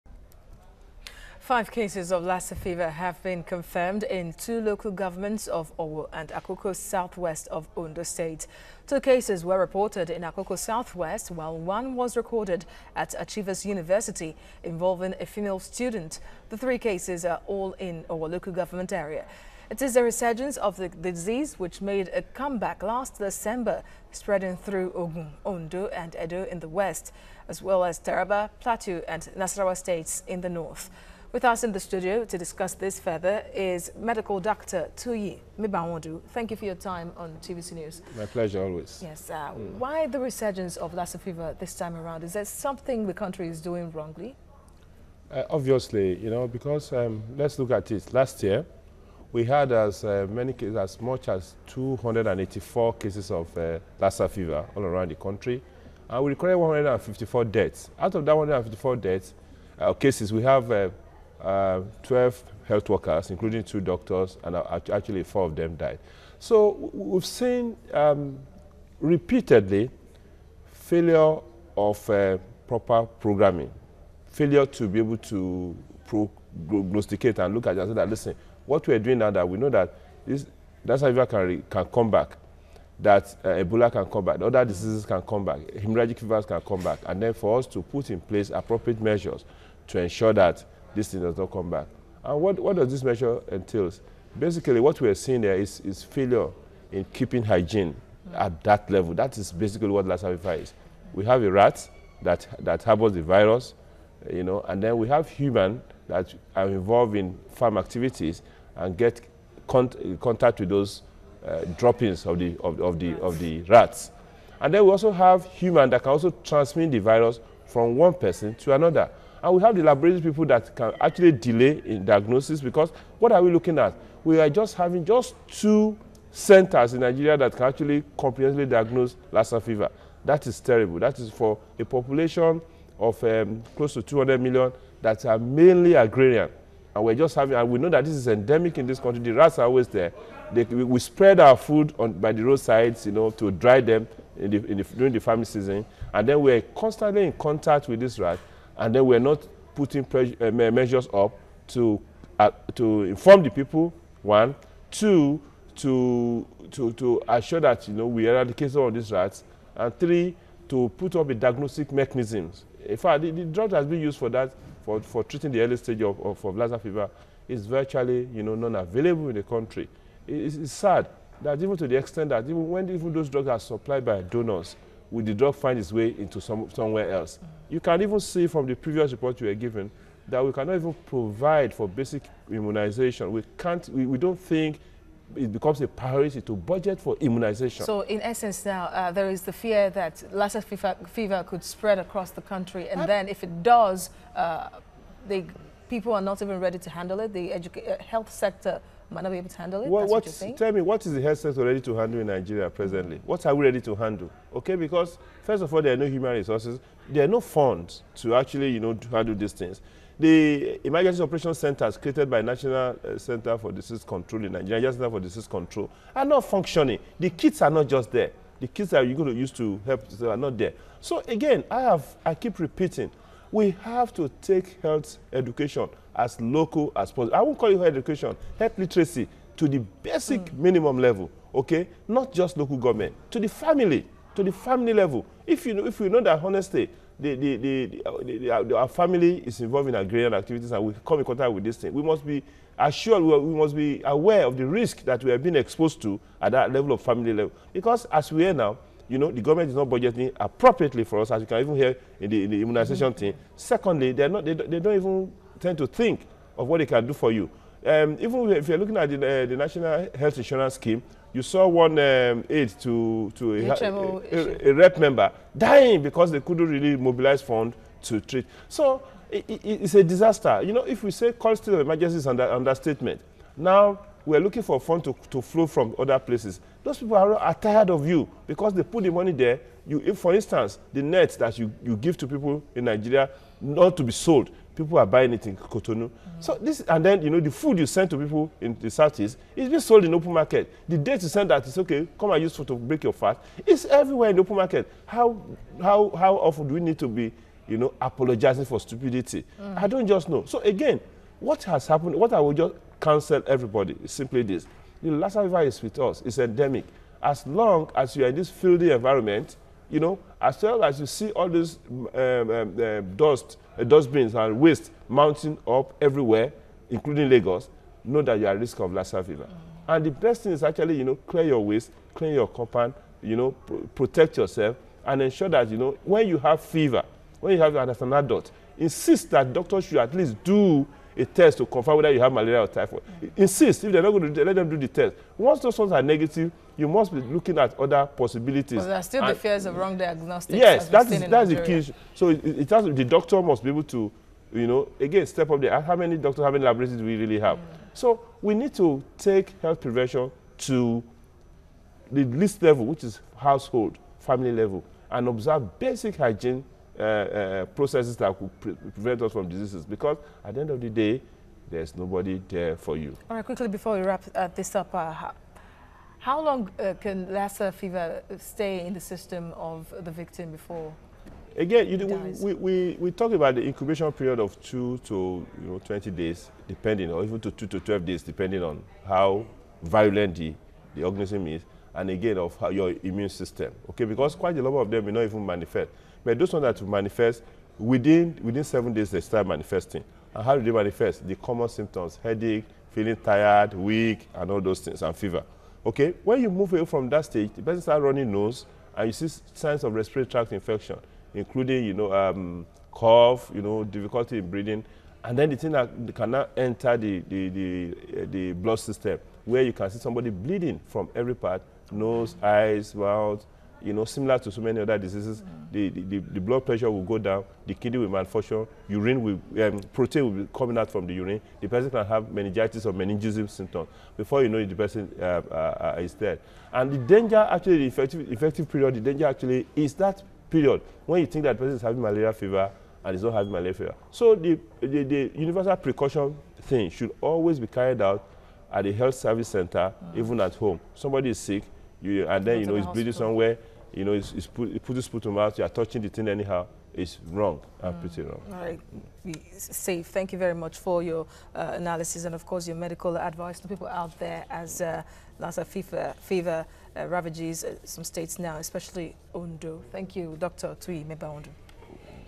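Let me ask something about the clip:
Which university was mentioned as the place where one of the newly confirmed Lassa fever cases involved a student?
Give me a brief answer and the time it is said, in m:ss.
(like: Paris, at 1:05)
Achievers University, at 0:13.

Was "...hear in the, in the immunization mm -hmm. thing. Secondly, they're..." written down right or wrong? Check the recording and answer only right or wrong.
right.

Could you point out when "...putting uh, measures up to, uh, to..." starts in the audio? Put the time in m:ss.
2:29.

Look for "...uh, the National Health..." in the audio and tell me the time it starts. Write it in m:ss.
4:19.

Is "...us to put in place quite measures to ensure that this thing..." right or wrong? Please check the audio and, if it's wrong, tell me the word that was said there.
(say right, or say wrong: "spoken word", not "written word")
wrong: "appropriate", not "quite".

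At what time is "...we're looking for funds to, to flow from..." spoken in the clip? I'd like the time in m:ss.
4:34.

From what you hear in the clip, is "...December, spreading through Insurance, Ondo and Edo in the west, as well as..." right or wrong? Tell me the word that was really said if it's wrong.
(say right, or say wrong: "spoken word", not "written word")
wrong: "Ogun", not "Insurance".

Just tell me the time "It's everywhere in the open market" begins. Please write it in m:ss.
4:53.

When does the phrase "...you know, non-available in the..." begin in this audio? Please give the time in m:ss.
2:48.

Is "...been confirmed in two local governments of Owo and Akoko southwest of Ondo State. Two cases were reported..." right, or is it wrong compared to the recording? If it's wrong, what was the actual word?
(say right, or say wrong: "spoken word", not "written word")
right.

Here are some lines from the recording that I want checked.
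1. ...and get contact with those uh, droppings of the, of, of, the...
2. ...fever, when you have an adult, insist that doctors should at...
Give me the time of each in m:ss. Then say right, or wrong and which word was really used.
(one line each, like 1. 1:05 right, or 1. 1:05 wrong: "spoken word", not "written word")
1. 1:48 right
2. 5:26 right.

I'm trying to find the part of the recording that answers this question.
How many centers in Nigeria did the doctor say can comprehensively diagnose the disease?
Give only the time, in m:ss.
2:05.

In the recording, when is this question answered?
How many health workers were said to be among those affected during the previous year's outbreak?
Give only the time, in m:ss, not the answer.
1:02.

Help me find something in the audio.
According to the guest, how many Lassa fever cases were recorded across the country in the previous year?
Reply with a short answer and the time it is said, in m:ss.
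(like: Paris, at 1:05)
284, at 0:51.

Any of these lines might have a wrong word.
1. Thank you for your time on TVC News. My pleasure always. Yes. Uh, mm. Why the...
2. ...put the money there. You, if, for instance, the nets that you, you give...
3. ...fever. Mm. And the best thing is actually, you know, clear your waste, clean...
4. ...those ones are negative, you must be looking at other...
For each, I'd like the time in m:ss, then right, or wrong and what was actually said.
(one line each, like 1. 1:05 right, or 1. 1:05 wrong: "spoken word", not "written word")
1. 0:36 right
2. 4:38 right
3. 5:19 right
4. 5:35 right.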